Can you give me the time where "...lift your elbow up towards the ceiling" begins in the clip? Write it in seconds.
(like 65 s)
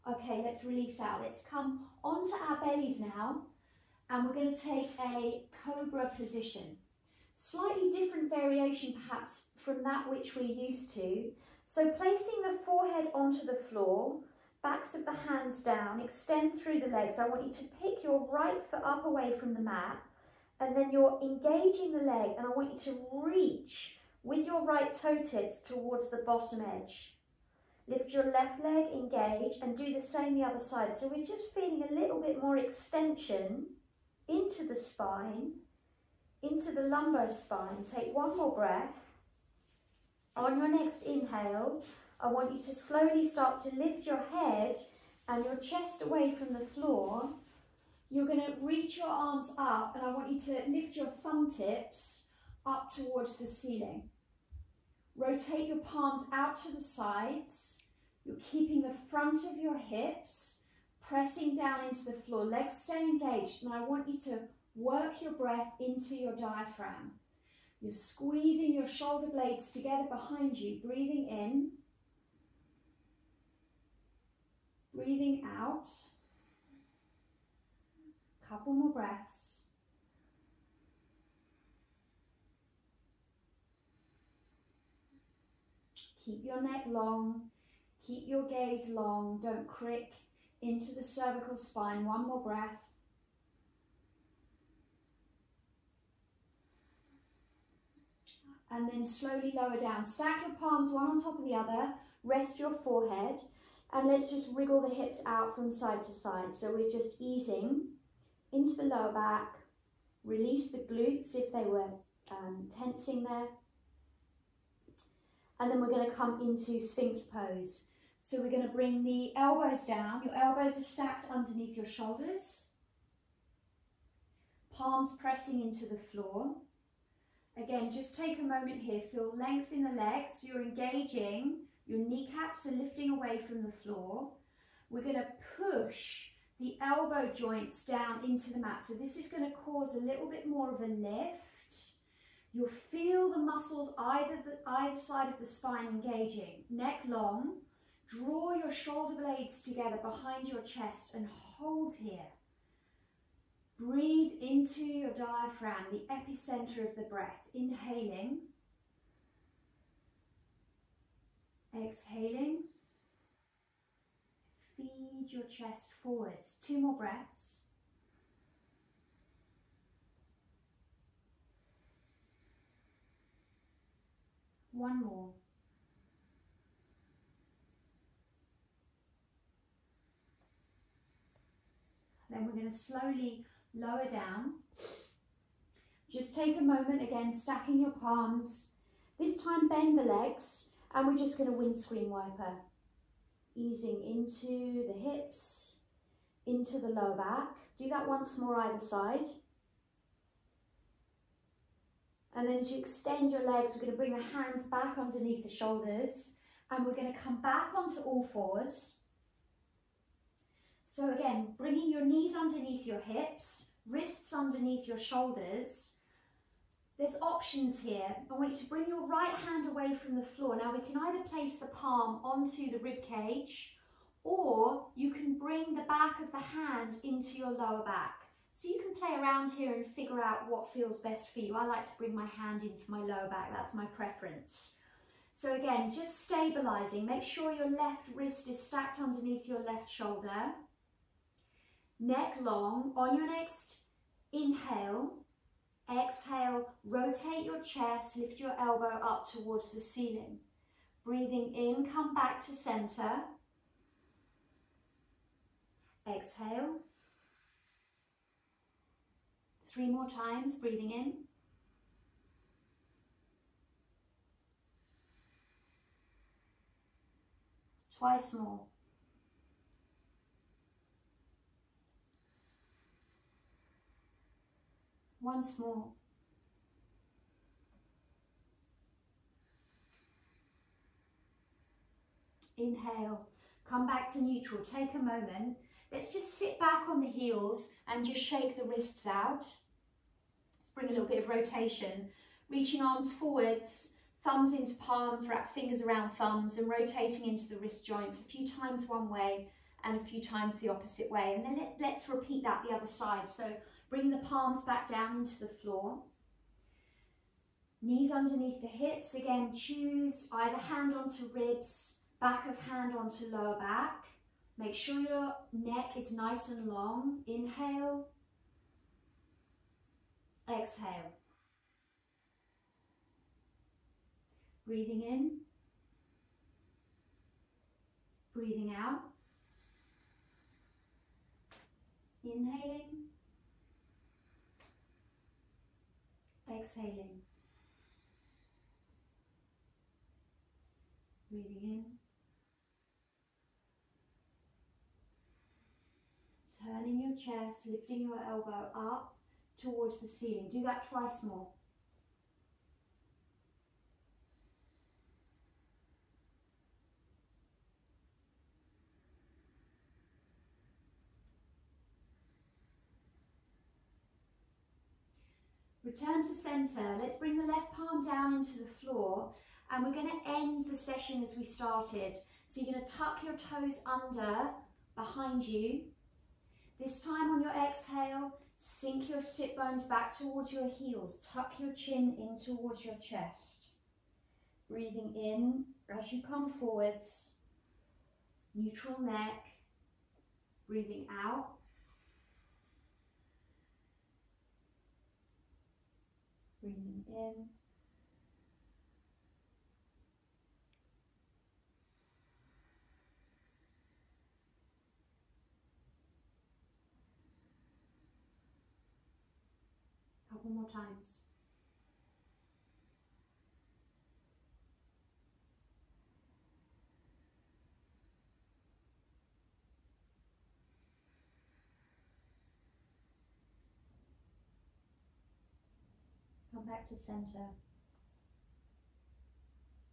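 248 s.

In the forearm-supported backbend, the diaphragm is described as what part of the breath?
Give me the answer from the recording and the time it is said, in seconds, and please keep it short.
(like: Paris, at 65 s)
The epicenter, at 156 s.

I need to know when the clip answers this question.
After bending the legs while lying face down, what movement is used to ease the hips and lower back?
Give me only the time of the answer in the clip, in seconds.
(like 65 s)
191 s.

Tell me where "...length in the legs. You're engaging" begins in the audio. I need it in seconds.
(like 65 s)
129 s.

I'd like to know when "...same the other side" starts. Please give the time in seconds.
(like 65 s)
30 s.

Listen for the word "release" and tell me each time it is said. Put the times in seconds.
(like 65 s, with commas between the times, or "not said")
0 s, 110 s.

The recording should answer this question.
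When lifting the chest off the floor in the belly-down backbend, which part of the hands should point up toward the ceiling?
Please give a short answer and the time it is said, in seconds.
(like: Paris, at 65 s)
Thumb tips, at 51 s.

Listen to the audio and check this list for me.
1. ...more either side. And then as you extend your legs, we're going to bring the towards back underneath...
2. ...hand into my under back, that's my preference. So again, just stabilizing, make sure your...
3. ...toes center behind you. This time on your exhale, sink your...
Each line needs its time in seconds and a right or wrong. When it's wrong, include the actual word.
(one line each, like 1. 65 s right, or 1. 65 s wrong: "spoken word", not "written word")
1. 198 s wrong: "hands", not "towards"
2. 232 s wrong: "lower", not "under"
3. 373 s wrong: "under", not "center".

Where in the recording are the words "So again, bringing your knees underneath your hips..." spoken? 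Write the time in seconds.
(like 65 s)
210 s.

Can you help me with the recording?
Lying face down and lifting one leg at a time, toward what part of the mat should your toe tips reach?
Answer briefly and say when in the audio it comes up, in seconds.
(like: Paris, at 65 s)
Bottom edge, at 26 s.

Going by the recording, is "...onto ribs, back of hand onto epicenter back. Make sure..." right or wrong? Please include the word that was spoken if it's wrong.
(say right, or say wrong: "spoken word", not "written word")
wrong: "lower", not "epicenter".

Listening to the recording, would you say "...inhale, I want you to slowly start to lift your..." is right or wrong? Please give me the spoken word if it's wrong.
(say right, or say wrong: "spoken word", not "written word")
right.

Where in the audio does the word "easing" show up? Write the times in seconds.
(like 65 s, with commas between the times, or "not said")
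107 s, 193 s.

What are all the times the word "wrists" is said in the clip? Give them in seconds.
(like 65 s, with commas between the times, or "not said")
213 s, 238 s, 288 s, 297 s.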